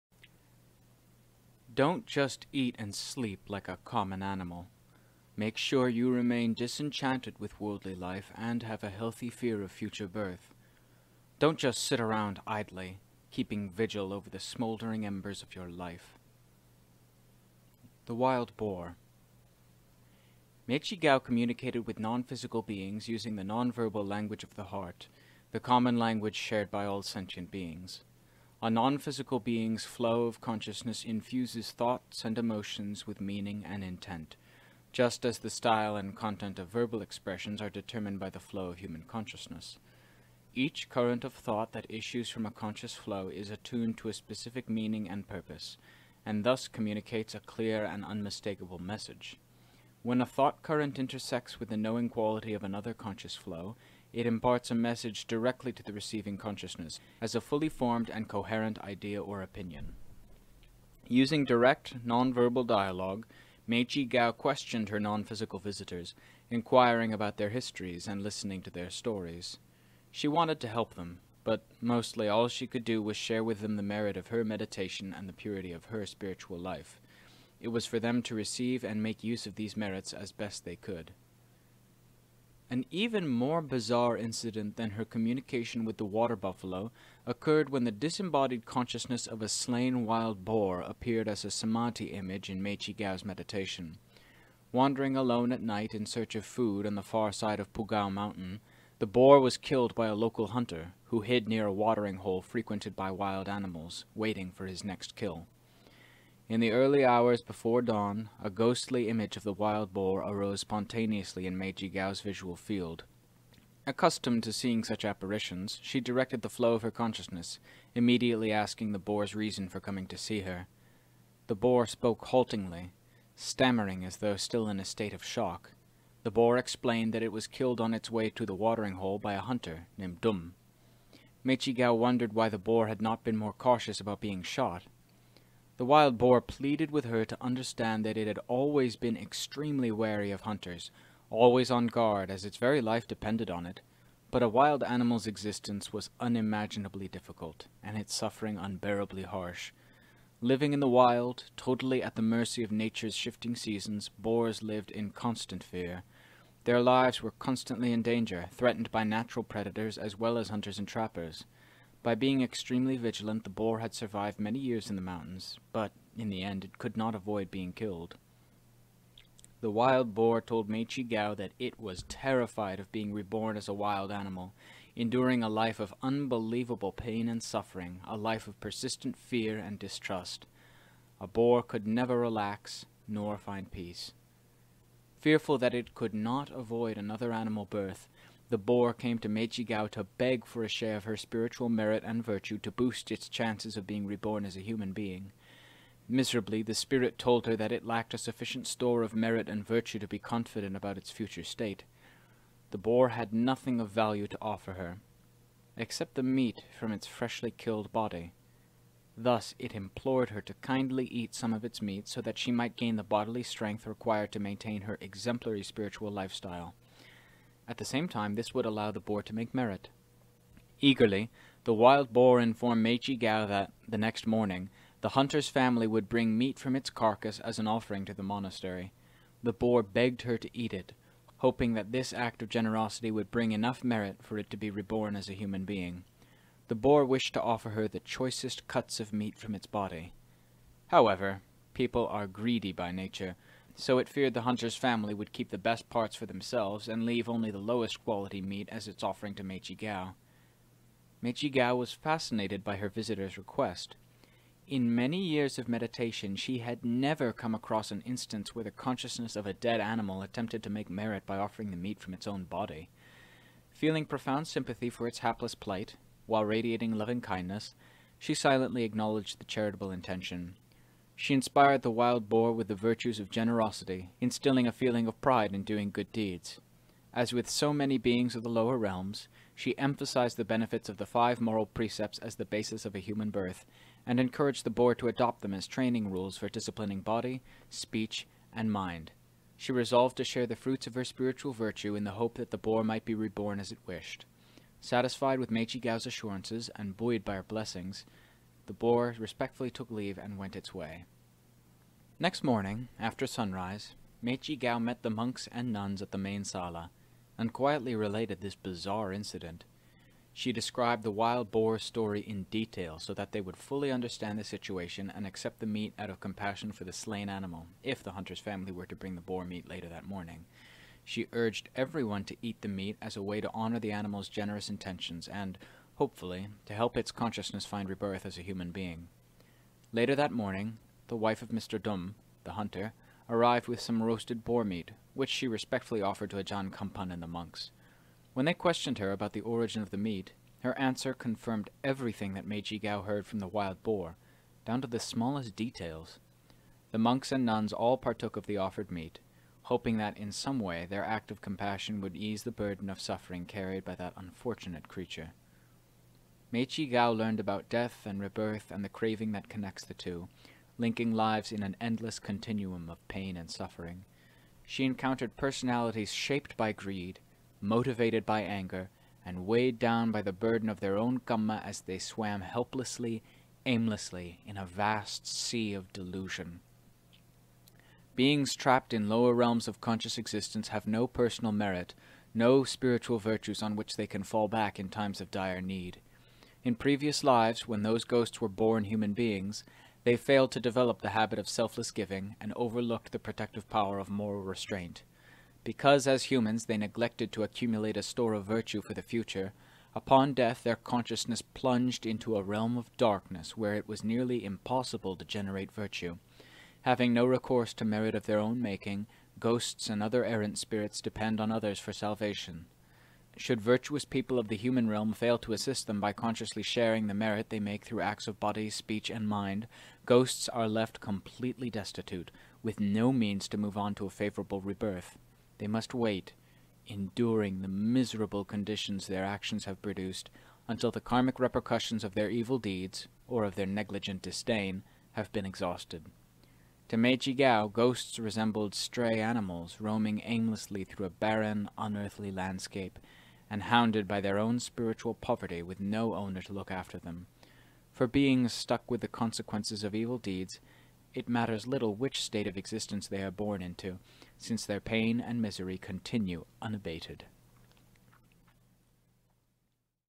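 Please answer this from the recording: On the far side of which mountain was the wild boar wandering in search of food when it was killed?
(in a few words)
Pugao Mountain.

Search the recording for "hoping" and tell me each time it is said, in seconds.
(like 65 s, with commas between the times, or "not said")
231 s, 349 s.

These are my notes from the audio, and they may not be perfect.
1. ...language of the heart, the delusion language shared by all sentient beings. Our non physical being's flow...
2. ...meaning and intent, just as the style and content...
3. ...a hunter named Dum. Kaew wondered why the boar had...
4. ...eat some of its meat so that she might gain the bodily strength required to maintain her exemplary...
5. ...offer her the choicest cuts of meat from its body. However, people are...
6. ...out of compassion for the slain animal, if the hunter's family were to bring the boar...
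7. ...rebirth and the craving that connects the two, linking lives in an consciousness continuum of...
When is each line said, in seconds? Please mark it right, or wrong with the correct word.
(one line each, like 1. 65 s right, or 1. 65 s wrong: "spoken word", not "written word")
1. 24 s wrong: "common", not "delusion"
2. 33 s right
3. 129 s right
4. 211 s right
5. 237 s right
6. 315 s right
7. 358 s wrong: "endless", not "consciousness".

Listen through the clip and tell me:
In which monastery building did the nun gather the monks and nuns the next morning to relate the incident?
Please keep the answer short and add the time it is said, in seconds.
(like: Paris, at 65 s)
main sala, at 306 s.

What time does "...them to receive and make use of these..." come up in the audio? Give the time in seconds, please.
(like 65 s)
77 s.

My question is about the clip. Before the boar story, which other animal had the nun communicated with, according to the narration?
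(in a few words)
water buffalo.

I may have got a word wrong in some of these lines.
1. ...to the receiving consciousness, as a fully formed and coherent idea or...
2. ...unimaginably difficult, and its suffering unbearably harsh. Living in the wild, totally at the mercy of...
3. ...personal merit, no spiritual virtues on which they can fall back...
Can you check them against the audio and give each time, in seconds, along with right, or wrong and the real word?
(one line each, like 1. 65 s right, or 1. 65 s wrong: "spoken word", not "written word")
1. 55 s right
2. 146 s right
3. 381 s right.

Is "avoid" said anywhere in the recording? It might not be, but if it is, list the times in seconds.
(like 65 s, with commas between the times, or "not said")
167 s, 186 s.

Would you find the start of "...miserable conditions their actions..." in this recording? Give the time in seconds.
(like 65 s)
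427 s.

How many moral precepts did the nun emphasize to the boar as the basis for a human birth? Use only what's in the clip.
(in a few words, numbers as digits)
5.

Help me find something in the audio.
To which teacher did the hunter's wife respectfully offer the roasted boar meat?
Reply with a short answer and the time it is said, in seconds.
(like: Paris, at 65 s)
Ajahn Kampan, at 336 s.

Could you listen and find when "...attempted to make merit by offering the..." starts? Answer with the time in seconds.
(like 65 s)
260 s.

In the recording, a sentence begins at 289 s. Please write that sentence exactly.
She resolved to share the fruits of her spiritual virtue in the hope that the boar might be reborn as it wished.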